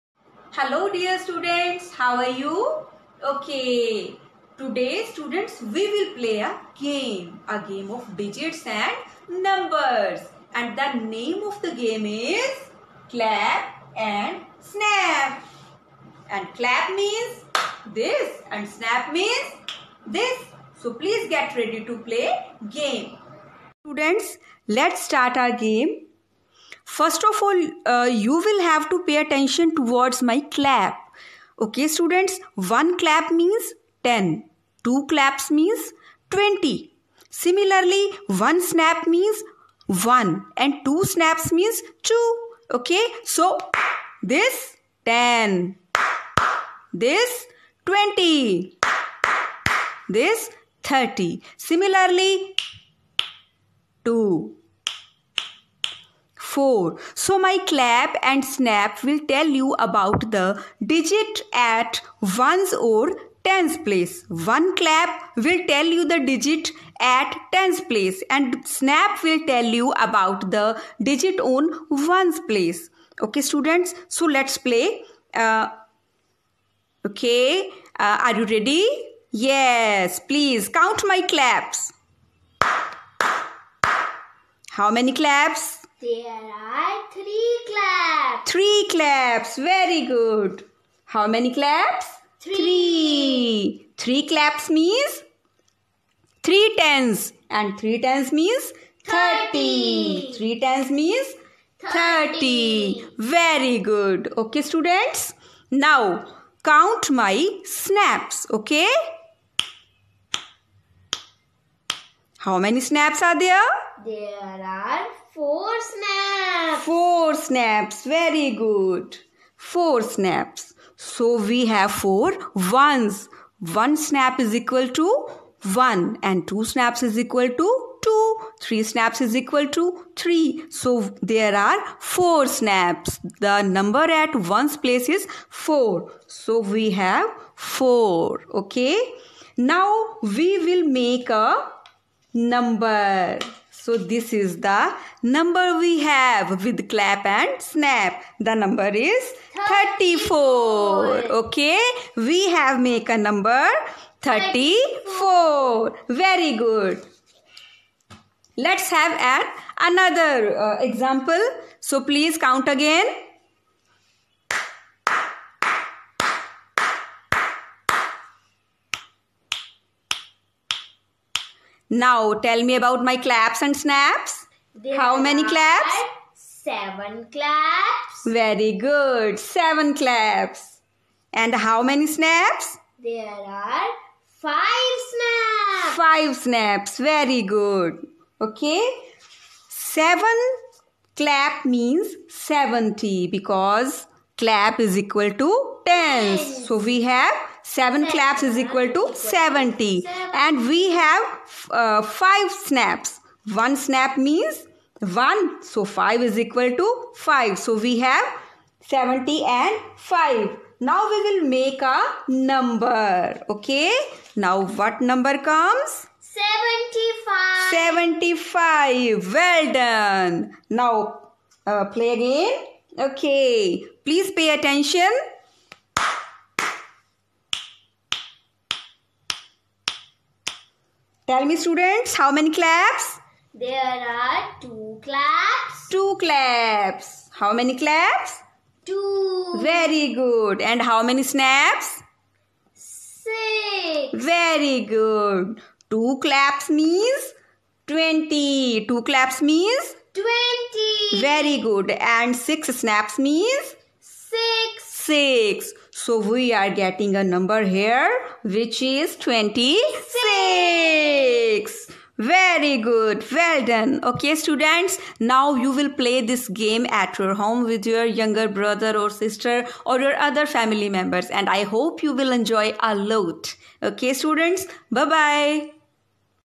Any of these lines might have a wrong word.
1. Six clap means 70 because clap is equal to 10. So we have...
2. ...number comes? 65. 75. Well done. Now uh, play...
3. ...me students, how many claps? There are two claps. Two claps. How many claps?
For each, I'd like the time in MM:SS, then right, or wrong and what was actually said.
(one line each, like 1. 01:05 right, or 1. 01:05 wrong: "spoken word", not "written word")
1. 03:09 wrong: "Seven", not "Six"
2. 03:34 wrong: "75", not "65"
3. 03:51 right.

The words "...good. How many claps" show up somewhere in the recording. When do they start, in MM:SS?
01:30.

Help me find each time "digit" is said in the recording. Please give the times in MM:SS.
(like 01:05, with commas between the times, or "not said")
00:08, 01:00, 01:06, 01:11.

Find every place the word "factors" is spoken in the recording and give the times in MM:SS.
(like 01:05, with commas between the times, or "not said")
not said.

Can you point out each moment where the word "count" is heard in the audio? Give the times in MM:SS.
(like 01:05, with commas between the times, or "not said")
01:20, 01:46, 02:42.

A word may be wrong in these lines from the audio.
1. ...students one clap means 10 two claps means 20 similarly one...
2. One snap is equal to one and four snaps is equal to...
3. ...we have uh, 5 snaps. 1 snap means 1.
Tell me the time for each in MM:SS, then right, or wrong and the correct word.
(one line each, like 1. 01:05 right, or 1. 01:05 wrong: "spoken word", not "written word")
1. 00:31 right
2. 02:03 wrong: "two", not "four"
3. 03:20 right.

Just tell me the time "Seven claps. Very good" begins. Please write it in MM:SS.
02:56.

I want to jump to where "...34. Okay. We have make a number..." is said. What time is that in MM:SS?
02:29.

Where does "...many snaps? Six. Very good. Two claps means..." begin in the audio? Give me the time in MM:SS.
04:01.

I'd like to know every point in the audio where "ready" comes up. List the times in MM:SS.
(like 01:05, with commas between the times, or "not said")
00:21, 01:18.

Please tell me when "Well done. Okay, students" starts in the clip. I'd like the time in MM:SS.
04:23.